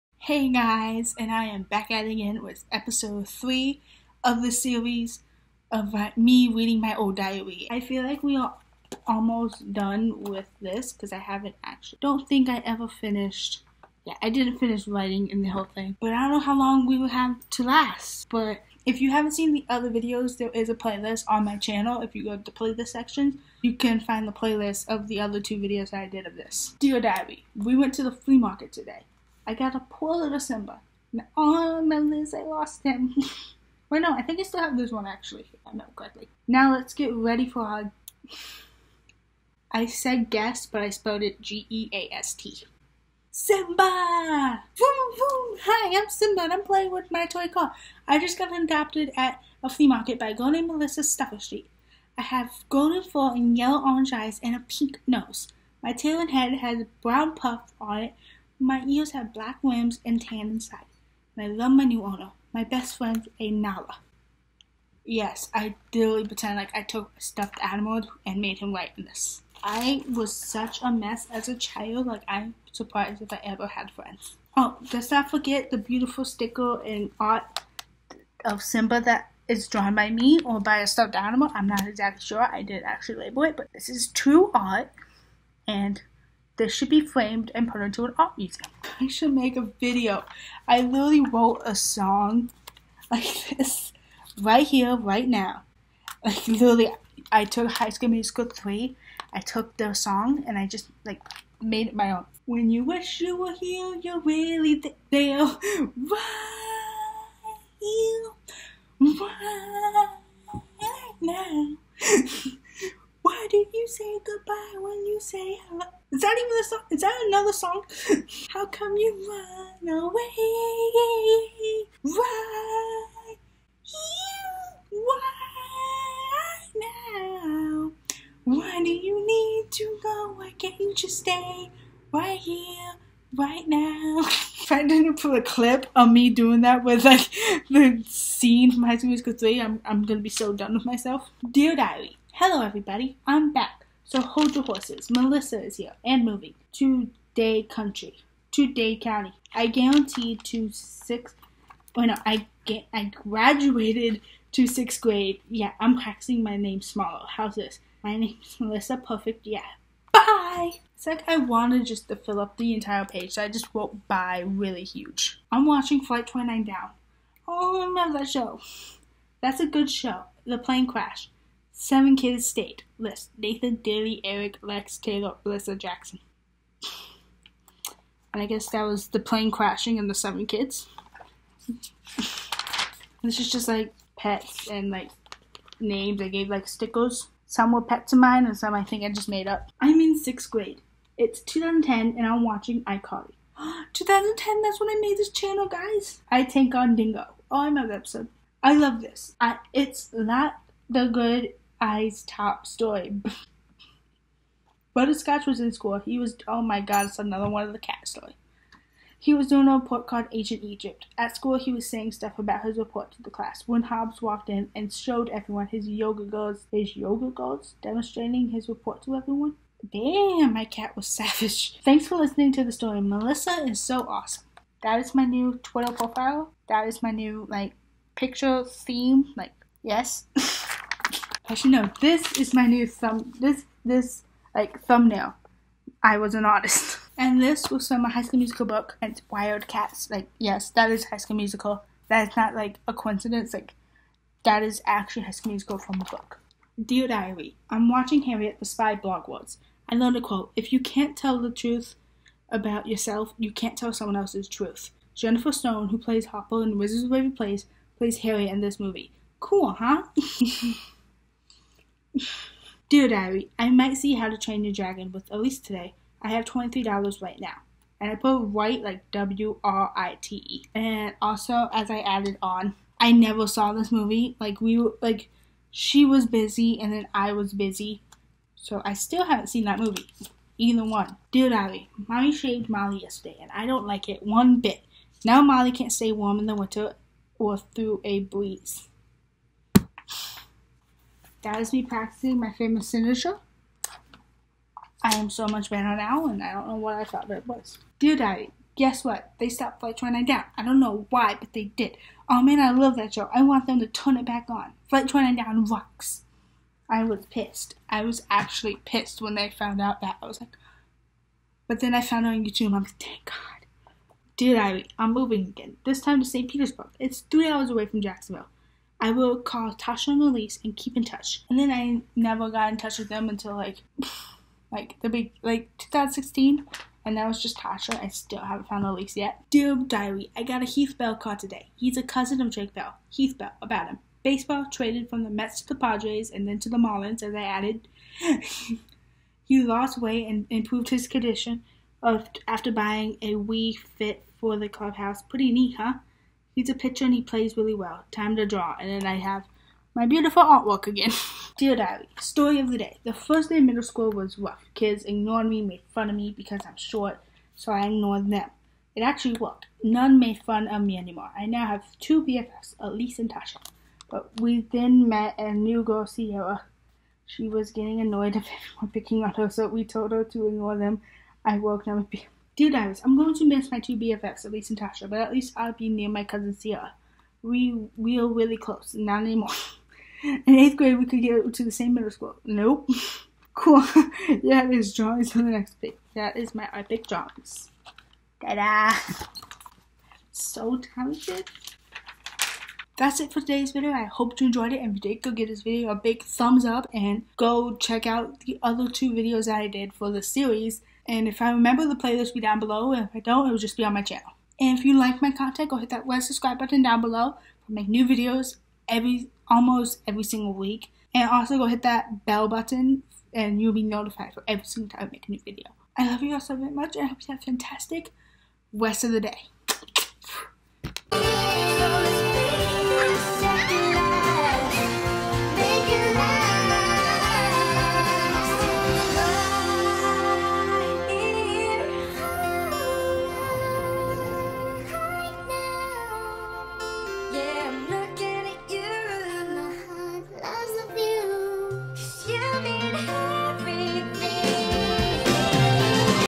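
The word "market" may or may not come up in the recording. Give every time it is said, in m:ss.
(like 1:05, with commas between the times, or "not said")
0:28, 0:49.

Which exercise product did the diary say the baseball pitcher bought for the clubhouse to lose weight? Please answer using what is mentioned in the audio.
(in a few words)
Wii Fit.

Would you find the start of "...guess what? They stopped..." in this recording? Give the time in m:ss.
4:58.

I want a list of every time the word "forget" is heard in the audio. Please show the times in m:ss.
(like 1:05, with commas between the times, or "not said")
1:15.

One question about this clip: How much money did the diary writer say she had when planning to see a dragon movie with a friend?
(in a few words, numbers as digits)
$23.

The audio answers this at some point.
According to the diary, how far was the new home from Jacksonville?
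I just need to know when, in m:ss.
5:17.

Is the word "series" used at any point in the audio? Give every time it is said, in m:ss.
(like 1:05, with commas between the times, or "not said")
0:04, 6:40.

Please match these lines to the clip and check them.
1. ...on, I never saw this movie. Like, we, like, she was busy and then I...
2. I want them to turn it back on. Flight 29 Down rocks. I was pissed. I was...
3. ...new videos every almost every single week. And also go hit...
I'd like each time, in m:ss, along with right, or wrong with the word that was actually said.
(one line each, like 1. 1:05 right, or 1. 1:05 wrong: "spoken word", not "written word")
1. 4:32 right
2. 5:03 right
3. 6:47 right.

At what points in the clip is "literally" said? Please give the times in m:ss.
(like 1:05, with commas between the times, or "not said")
1:05, 1:30, 1:36.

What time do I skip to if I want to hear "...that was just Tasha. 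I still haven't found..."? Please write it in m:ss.
5:27.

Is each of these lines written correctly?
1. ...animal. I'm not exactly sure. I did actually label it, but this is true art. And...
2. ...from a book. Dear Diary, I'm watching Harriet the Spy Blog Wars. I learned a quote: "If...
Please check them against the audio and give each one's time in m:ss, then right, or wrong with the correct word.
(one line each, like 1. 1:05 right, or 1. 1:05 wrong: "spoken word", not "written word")
1. 1:21 right
2. 4:05 right.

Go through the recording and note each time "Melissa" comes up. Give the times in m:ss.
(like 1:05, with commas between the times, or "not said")
0:50, 2:25, 2:38, 2:55, 3:43.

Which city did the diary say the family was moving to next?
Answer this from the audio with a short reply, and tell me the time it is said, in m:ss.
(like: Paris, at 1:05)
St. Petersburg, at 5:16.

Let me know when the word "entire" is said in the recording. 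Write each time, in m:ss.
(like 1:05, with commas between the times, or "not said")
2:42.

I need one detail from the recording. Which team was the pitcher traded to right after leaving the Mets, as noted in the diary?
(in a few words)
Padres.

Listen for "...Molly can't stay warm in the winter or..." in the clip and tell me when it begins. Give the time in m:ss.
4:45.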